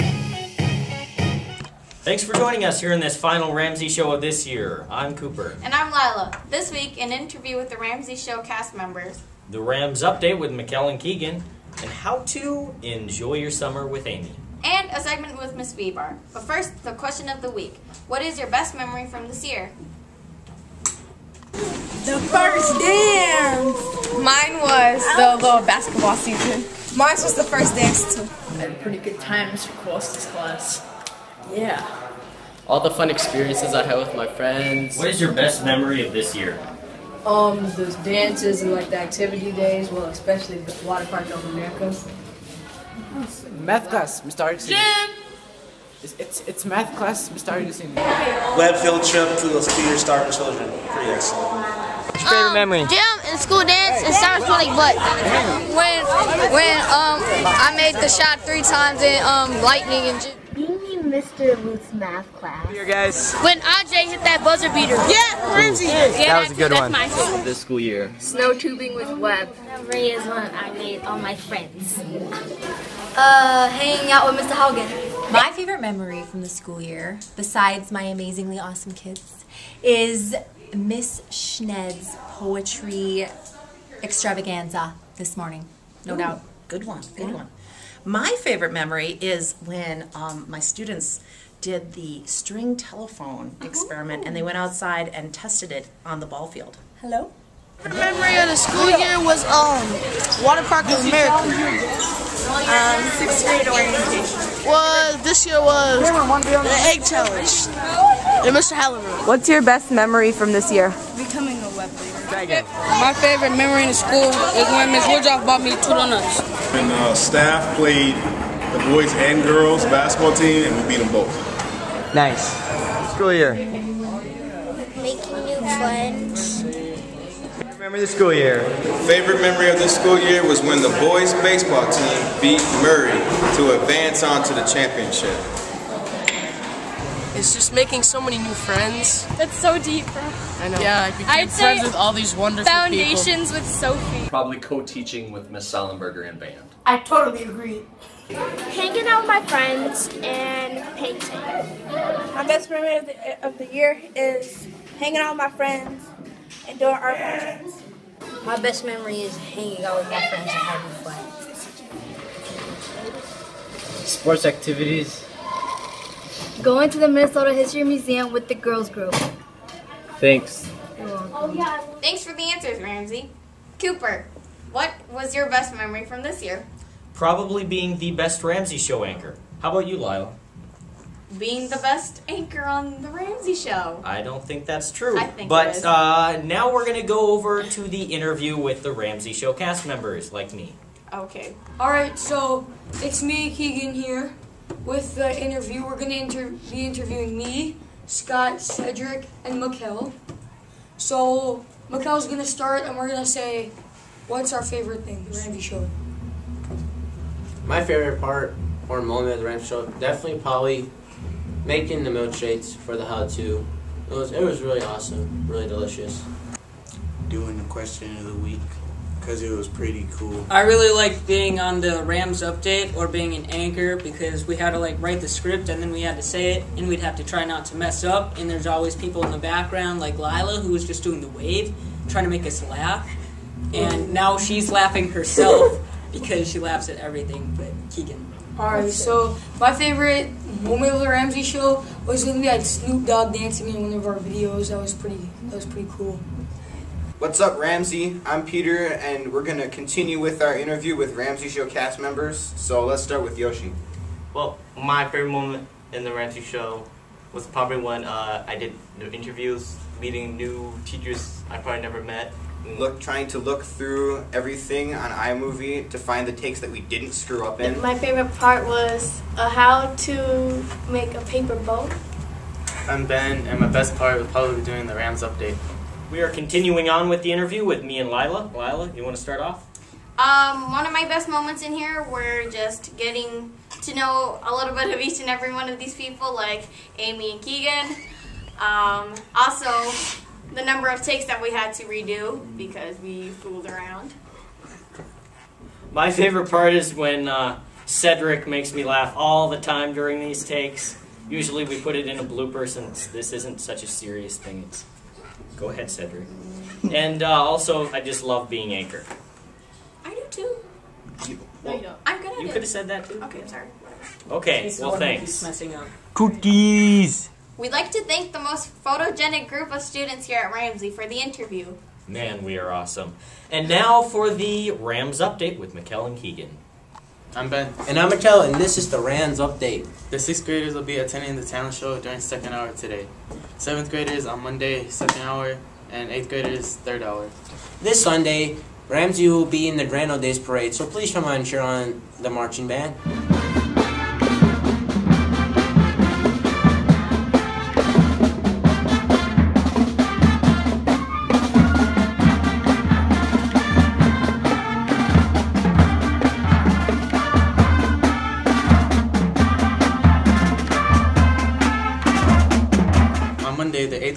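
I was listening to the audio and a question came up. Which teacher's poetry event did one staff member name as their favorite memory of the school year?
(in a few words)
Miss Schned.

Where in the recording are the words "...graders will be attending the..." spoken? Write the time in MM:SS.
05:30.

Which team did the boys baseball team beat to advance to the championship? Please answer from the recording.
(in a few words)
Murray.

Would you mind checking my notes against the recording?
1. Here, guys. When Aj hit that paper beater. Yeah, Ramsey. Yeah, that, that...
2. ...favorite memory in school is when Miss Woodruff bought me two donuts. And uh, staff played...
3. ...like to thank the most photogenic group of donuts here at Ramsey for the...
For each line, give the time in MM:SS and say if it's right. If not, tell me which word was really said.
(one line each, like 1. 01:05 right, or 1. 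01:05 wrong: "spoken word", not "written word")
1. 01:02 wrong: "buzzer", not "paper"
2. 01:53 right
3. 05:17 wrong: "students", not "donuts".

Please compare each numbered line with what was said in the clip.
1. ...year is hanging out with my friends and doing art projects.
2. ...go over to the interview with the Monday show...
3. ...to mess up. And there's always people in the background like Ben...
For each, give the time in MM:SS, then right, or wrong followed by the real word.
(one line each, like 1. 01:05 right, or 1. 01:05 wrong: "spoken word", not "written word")
1. 02:33 right
2. 03:07 wrong: "Ramsey", not "Monday"
3. 03:47 wrong: "Lila", not "Ben".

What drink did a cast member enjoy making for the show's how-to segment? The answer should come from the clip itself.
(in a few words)
milkshakes.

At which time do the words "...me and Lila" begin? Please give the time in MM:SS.
04:37.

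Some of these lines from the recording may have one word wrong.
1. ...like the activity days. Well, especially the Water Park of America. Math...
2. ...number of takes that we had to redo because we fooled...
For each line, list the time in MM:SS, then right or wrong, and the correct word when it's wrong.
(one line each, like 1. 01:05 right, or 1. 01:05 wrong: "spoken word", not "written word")
1. 00:38 right
2. 04:50 right.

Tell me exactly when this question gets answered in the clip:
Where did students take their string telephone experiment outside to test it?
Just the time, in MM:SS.
01:36.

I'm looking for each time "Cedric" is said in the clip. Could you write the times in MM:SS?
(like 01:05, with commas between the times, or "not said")
03:18, 04:57, 05:05.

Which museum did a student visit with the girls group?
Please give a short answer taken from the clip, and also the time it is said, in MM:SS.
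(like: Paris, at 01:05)
Minnesota History Museum, at 02:47.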